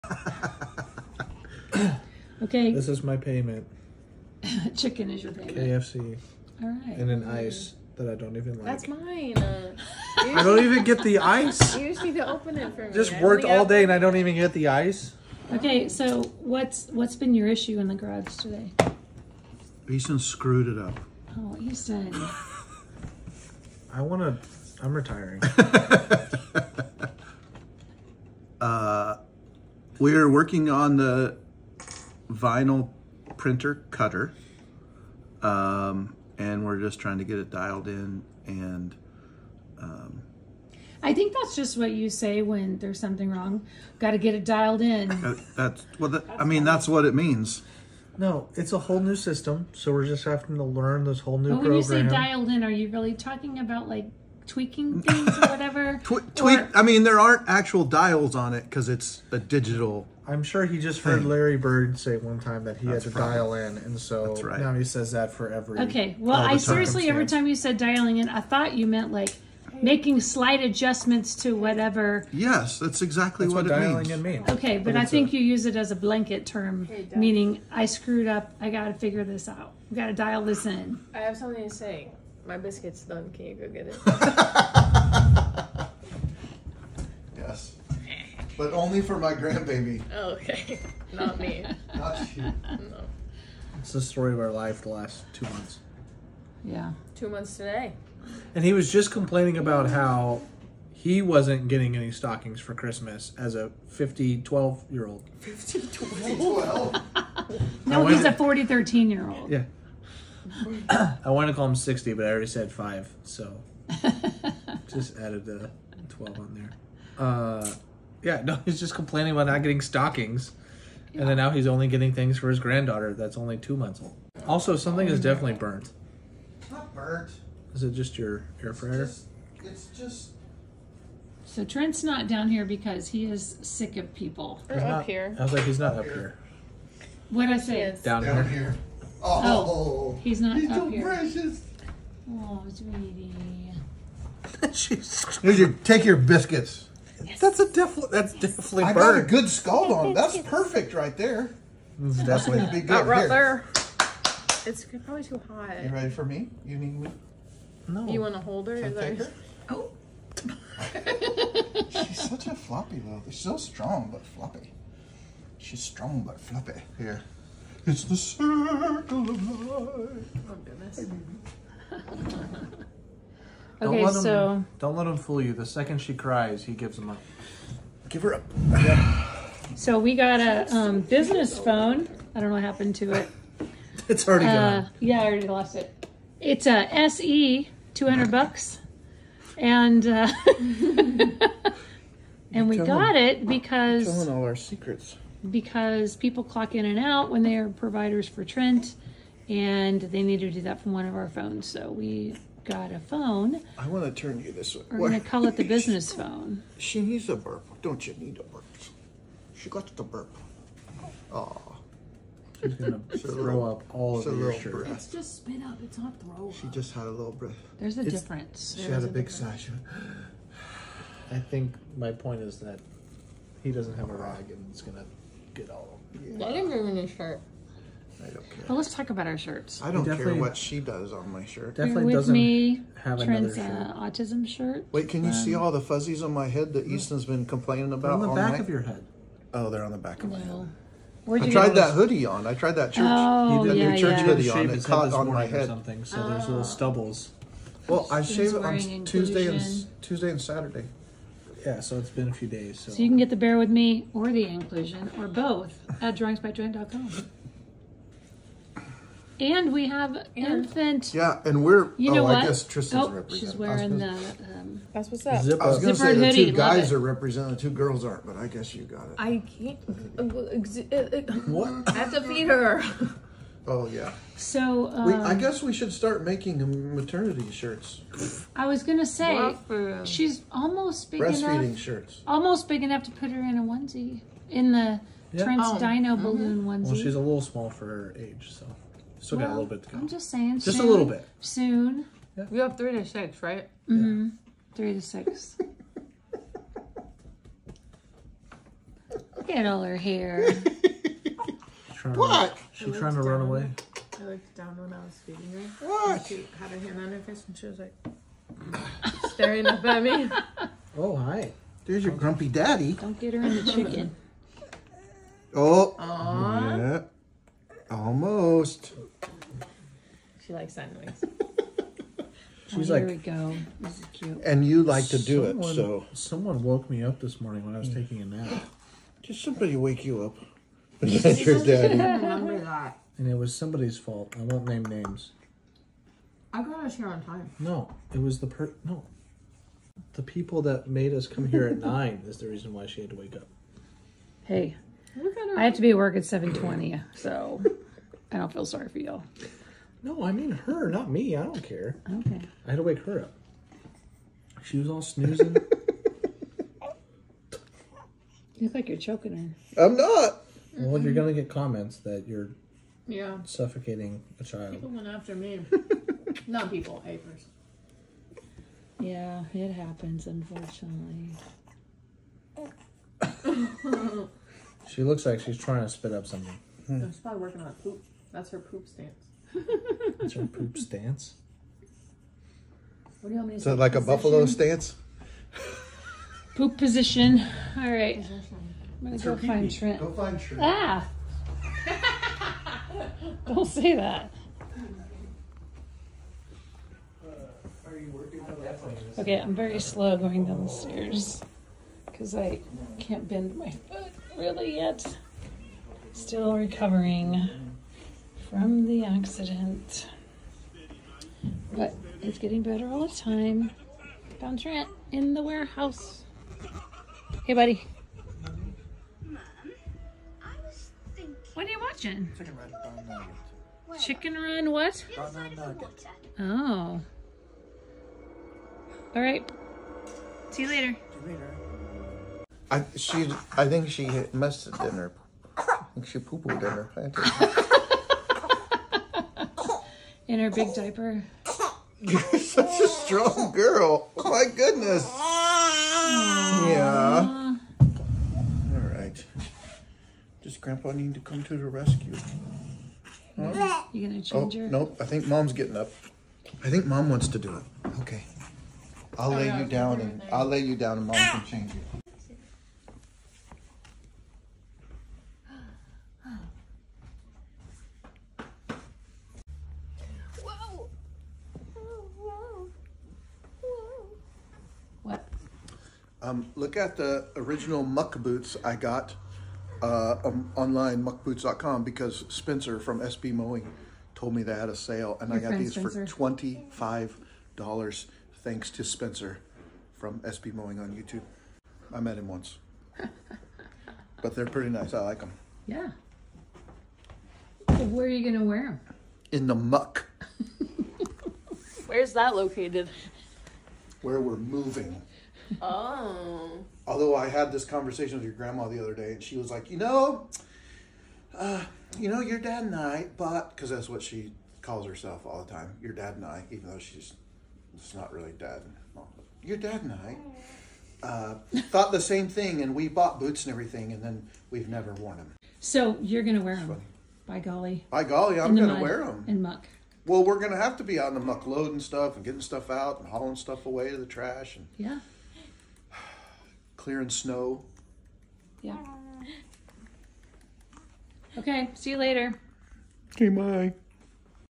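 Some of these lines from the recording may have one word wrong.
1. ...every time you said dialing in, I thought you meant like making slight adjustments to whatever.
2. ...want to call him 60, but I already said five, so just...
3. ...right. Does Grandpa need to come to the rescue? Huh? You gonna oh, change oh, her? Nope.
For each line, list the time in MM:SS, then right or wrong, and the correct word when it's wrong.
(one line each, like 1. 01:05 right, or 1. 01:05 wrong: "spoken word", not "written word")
1. 01:07 right
2. 01:51 right
3. 07:28 right.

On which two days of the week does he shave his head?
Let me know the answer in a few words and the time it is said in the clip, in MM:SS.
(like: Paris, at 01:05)
Tuesday and Saturday, at 04:10.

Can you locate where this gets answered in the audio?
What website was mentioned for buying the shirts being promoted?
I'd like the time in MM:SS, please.
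04:16.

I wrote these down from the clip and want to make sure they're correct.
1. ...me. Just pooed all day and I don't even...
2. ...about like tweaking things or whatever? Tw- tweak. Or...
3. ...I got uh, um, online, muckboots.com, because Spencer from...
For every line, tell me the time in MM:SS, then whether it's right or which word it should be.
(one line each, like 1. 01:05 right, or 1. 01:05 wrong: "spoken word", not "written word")
1. 00:12 wrong: "worked", not "pooed"
2. 00:53 right
3. 07:58 right.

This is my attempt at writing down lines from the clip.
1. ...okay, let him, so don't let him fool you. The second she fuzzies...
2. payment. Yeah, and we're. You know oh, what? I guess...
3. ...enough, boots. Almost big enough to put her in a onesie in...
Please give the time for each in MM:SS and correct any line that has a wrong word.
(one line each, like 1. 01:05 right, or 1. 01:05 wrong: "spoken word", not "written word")
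1. 02:53 wrong: "cries", not "fuzzies"
2. 04:20 wrong: "infant", not "payment"
3. 04:41 wrong: "shirts", not "boots".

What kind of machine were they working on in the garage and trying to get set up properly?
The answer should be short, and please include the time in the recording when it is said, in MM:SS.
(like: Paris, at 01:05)
vinyl printer cutter, at 00:32.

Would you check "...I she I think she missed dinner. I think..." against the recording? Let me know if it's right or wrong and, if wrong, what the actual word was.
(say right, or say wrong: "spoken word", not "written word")
right.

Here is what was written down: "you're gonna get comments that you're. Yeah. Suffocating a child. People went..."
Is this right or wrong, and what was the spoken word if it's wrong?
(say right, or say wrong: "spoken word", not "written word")
right.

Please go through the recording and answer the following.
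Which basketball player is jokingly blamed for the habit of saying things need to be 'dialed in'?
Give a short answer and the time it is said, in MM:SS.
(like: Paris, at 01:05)
Larry Bird, at 01:01.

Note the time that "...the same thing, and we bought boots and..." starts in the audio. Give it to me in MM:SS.
08:41.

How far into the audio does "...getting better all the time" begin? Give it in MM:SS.
06:52.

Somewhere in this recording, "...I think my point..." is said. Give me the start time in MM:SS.
03:41.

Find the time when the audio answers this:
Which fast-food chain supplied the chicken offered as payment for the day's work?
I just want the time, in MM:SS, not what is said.
00:05.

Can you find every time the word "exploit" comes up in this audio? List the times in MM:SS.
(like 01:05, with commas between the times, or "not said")
not said.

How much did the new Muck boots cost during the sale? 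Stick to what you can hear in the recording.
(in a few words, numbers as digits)
$25.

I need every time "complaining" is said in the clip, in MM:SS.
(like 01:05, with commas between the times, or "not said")
01:39, 01:58, 03:57.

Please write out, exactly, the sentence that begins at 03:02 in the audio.
I don't know what happened to it.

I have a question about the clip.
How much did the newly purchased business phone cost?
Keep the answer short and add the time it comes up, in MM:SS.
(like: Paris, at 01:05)
$200, at 03:07.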